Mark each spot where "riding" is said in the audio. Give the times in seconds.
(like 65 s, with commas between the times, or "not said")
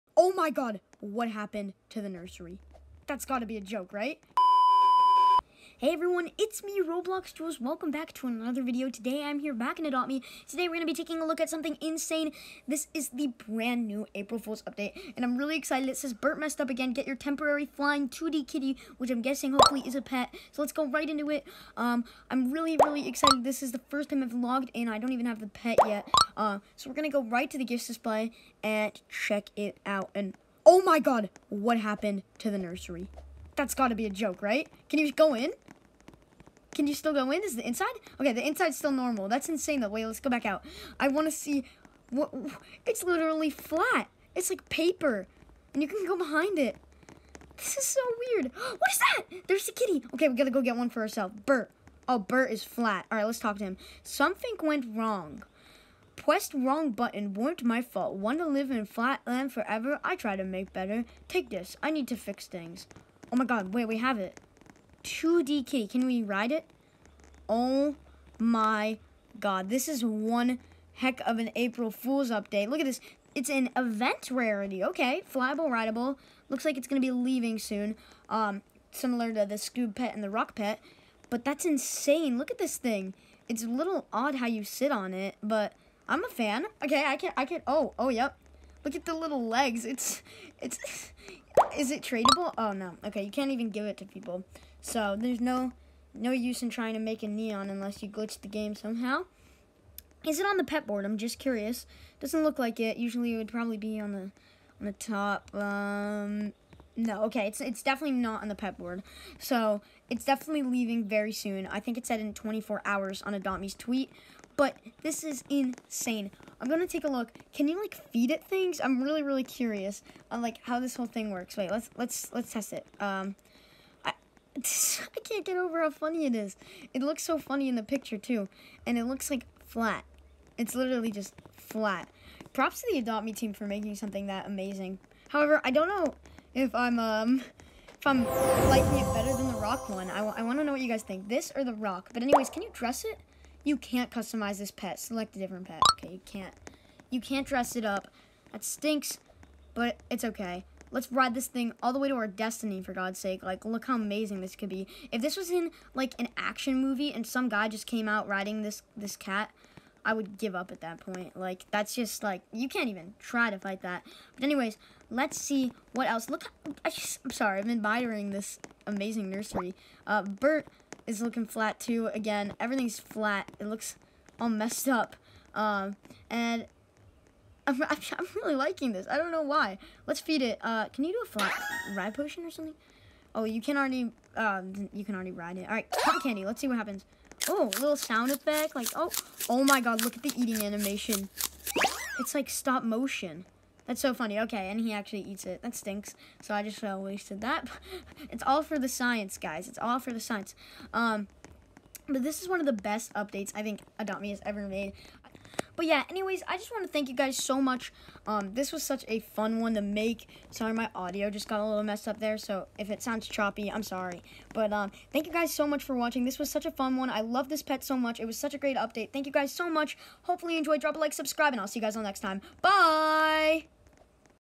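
158 s.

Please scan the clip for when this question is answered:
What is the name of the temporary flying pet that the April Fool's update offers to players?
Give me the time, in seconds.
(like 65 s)
18 s.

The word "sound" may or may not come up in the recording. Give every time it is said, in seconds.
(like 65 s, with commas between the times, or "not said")
187 s, 213 s.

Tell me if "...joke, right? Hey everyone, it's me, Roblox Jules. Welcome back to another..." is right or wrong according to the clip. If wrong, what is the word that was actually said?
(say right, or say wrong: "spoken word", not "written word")
right.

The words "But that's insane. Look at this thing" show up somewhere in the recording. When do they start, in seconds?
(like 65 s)
81 s.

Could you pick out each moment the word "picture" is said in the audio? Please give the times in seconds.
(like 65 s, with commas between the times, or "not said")
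127 s.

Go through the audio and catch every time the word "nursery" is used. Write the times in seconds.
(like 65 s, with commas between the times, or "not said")
2 s, 32 s, 169 s.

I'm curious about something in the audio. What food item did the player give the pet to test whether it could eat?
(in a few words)
Cotton candy.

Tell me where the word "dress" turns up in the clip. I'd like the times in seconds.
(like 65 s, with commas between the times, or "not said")
142 s, 147 s.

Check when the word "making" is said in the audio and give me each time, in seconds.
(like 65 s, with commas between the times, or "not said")
133 s.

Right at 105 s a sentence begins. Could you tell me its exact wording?
Um, no, okay, it's it's definitely not on the pet board.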